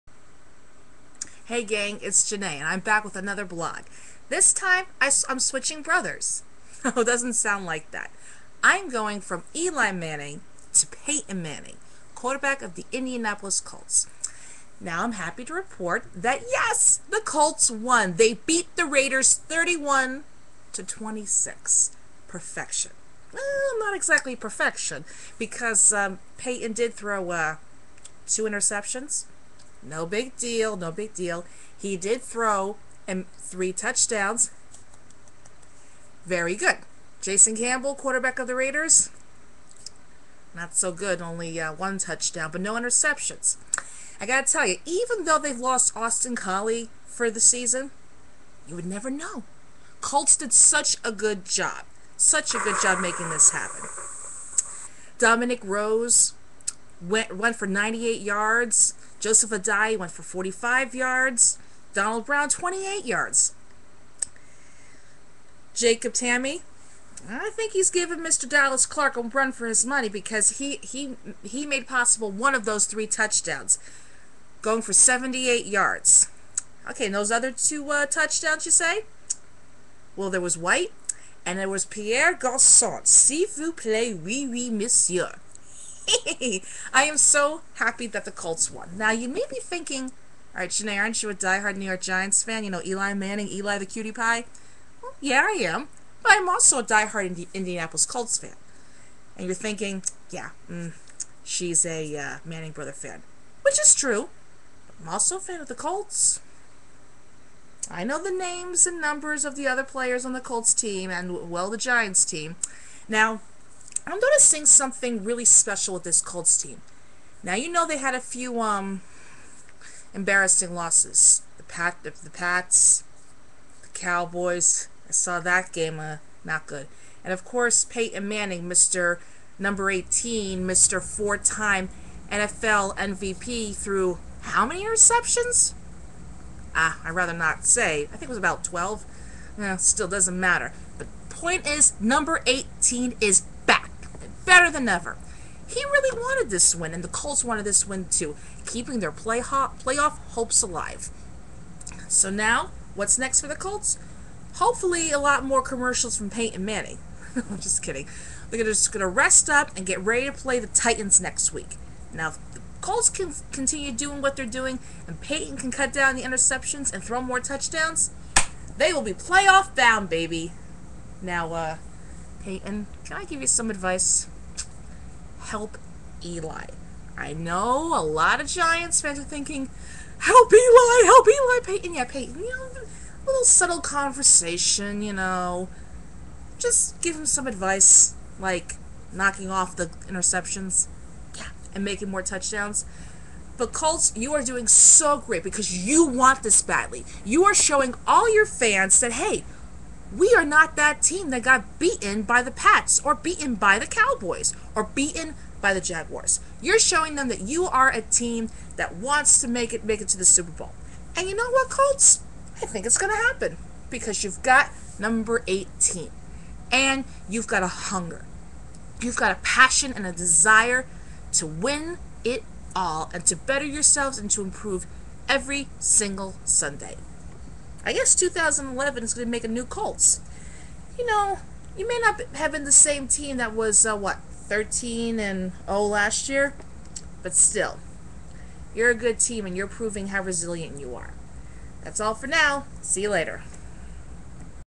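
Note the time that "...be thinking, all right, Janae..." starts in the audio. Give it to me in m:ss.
1:29.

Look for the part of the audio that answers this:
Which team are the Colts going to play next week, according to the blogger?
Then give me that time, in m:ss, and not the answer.
2:40.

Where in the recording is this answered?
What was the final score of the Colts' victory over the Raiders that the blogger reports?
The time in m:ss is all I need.
0:19.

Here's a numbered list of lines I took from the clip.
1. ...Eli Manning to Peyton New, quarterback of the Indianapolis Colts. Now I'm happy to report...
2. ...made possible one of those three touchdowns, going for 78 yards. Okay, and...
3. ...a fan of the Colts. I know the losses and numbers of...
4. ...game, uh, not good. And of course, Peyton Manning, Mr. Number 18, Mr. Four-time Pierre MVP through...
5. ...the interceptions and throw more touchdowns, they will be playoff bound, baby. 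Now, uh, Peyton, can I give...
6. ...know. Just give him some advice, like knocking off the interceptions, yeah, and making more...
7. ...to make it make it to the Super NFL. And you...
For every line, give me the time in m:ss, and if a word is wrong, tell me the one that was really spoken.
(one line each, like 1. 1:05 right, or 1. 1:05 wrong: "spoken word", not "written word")
1. 0:09 wrong: "Manning", not "New"
2. 1:11 right
3. 1:45 wrong: "names", not "losses"
4. 2:05 wrong: "NFL", not "Pierre"
5. 2:46 right
6. 3:05 right
7. 3:29 wrong: "Bowl", not "NFL".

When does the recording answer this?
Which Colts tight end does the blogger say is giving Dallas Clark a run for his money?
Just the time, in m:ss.
1:05.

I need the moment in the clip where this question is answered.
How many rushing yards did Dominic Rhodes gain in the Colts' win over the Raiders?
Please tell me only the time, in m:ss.
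0:57.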